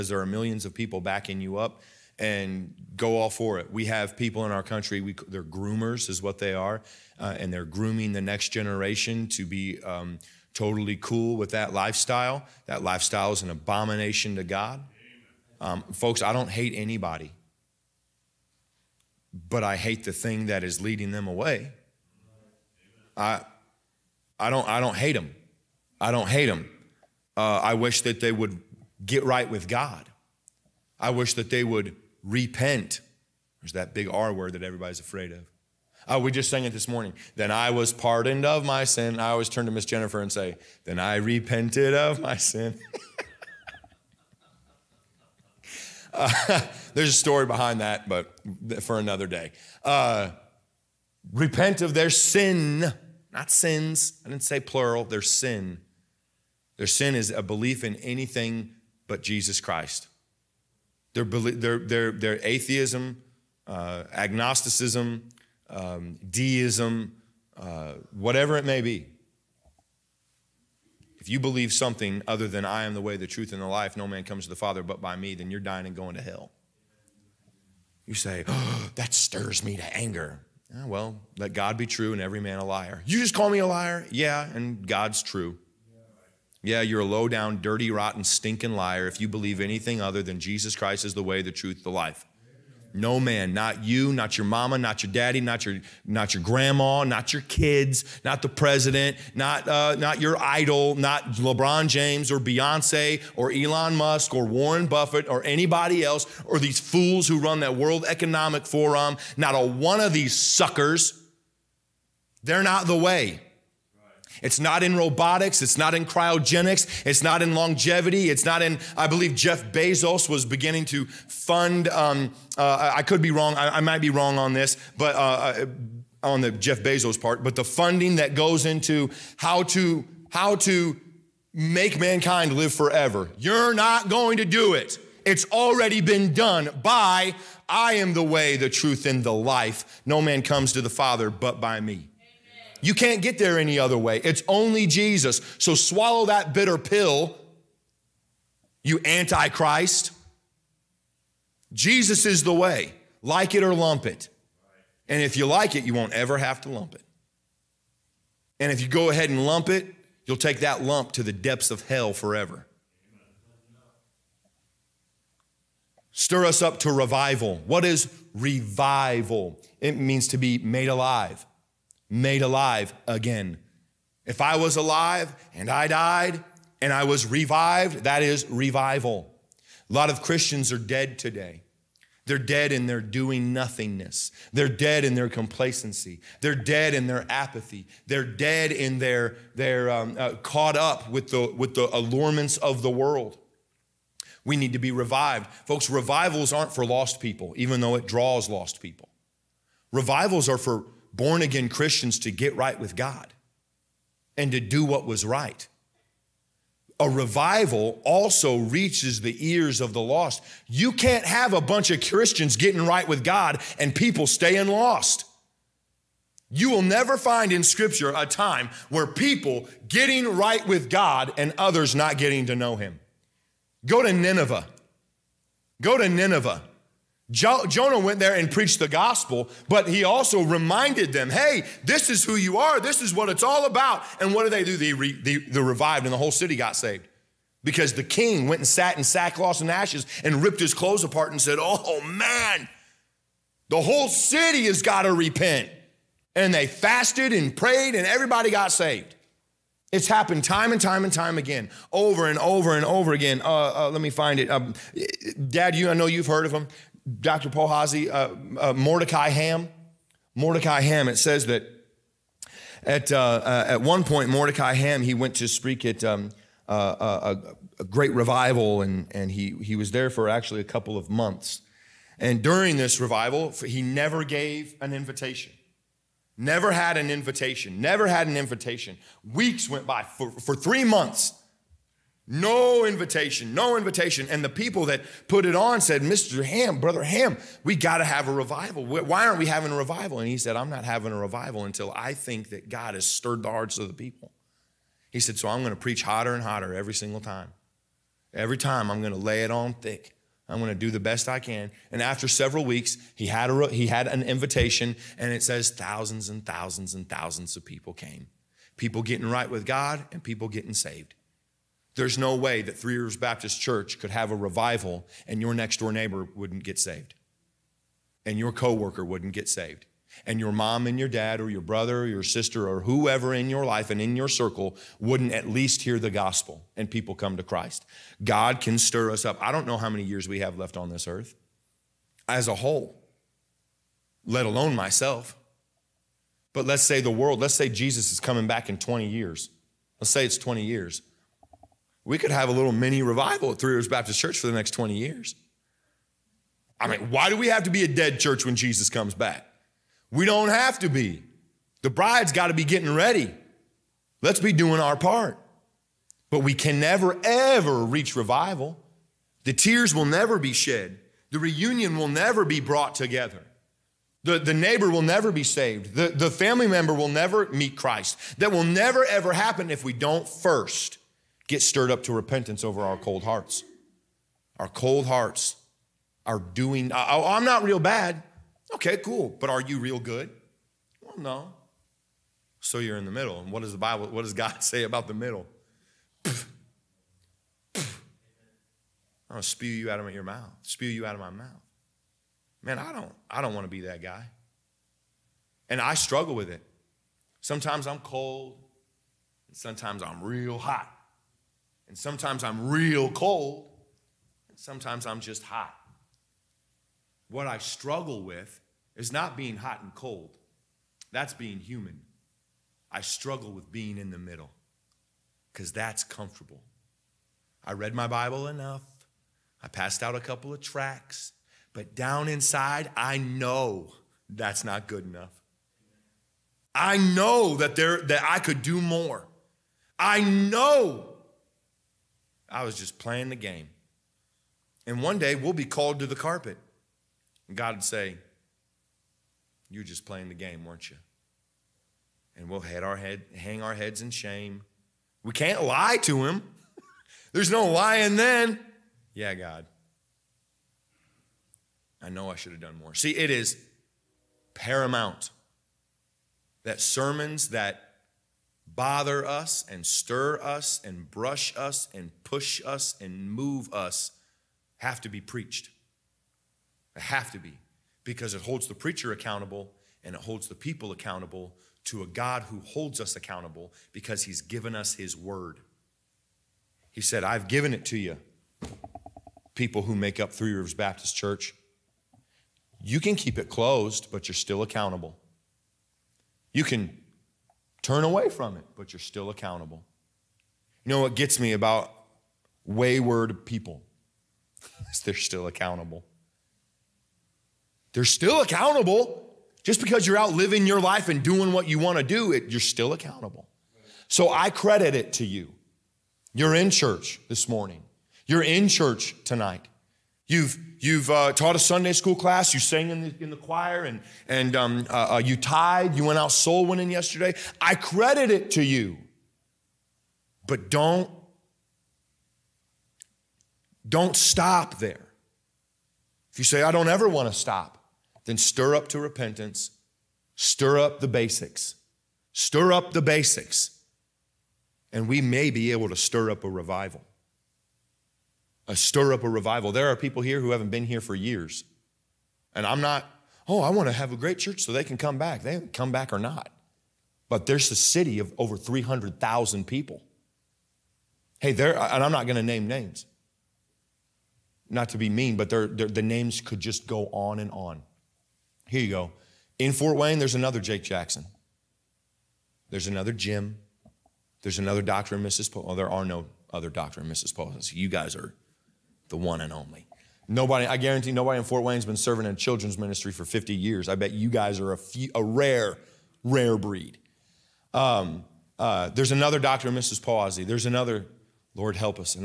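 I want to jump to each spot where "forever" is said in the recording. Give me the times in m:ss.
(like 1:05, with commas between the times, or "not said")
2:12, 2:42.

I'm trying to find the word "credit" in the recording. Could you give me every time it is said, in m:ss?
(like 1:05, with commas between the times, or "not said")
8:24, 8:37.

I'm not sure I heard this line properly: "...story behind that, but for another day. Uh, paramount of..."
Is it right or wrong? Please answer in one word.
wrong.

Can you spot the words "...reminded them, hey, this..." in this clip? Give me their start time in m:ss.
3:50.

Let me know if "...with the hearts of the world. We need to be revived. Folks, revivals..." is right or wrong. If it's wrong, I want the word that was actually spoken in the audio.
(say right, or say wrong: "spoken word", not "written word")
wrong: "allurements", not "hearts".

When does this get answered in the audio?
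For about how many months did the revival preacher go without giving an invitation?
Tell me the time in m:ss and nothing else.
4:40.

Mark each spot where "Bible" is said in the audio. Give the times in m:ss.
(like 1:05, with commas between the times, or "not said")
6:23, 6:58.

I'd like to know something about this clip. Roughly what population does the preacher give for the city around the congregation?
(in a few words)
over 300,000.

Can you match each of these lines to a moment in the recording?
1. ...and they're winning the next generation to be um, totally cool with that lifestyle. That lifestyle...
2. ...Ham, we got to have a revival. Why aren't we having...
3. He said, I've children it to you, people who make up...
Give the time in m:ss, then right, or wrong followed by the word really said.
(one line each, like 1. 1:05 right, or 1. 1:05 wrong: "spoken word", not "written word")
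1. 0:07 wrong: "grooming", not "winning"
2. 4:47 right
3. 7:56 wrong: "given", not "children".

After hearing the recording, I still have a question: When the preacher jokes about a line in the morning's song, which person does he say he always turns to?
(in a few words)
Miss Jennifer.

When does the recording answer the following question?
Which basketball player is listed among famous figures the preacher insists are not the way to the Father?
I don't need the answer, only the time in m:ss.
1:41.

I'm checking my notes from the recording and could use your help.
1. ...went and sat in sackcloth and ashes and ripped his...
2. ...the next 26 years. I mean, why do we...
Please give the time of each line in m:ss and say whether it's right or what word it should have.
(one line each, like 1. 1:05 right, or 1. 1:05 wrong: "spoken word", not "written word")
1. 3:58 right
2. 5:44 wrong: "20", not "26".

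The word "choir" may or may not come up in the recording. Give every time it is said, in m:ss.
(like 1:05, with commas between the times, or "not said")
8:33.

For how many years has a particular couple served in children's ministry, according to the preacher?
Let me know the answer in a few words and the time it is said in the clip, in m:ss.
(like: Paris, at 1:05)
50, at 9:33.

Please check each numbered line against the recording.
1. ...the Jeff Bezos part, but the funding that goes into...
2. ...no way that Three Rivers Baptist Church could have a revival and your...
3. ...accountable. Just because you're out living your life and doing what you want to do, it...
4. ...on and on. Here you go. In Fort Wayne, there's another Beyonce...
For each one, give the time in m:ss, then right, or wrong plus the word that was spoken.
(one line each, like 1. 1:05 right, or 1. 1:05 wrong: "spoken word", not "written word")
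1. 2:06 right
2. 5:12 right
3. 8:18 right
4. 9:17 wrong: "Jake", not "Beyonce".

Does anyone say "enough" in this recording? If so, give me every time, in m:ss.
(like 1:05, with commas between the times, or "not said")
6:58, 7:05.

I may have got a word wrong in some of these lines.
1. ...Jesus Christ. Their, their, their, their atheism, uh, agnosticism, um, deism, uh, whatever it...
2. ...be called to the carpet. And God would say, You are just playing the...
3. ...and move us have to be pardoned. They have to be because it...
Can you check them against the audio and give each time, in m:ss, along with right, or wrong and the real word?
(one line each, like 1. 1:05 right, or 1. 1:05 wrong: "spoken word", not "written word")
1. 0:59 right
2. 7:15 right
3. 7:43 wrong: "preached", not "pardoned".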